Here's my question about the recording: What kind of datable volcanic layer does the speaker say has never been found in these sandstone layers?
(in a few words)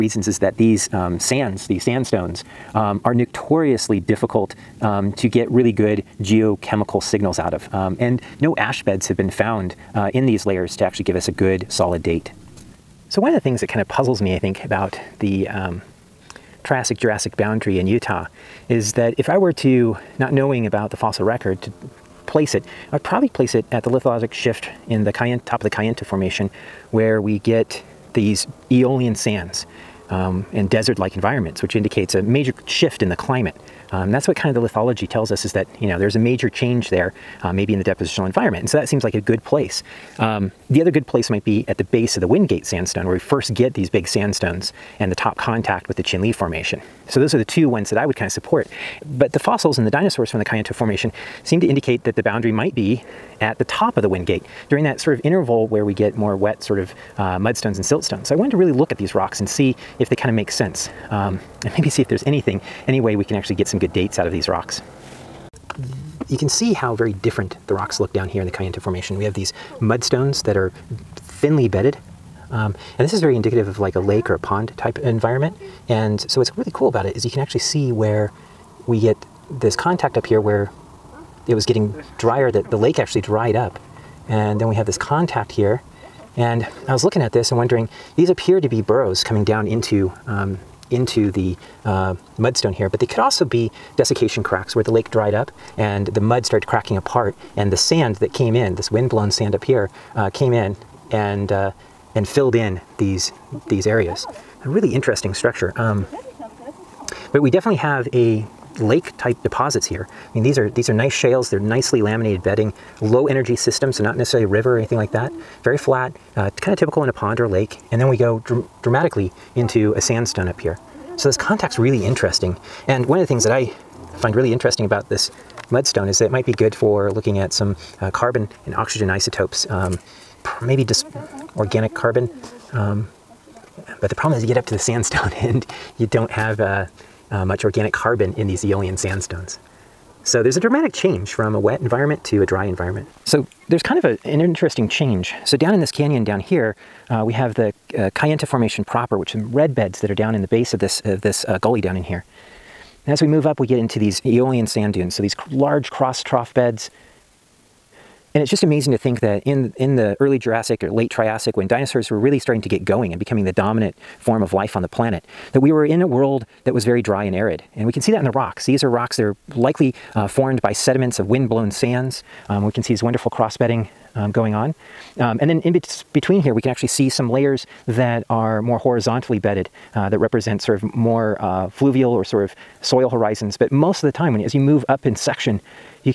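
Ash beds.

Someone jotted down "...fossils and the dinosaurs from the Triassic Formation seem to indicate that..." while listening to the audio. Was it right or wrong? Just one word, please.
wrong.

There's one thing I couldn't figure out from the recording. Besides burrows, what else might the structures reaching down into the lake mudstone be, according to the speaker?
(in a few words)
Desiccation cracks.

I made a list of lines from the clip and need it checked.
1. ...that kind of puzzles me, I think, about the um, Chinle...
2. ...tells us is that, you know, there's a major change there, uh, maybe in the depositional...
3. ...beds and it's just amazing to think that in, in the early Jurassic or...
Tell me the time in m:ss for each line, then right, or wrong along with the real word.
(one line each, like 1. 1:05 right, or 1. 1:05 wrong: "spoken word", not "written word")
1. 0:13 wrong: "Triassic", not "Chinle"
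2. 0:35 right
3. 2:36 right.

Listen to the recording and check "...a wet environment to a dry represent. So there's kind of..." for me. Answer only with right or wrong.
wrong.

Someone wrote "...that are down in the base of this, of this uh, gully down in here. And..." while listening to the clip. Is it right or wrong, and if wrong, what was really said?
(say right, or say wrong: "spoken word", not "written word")
right.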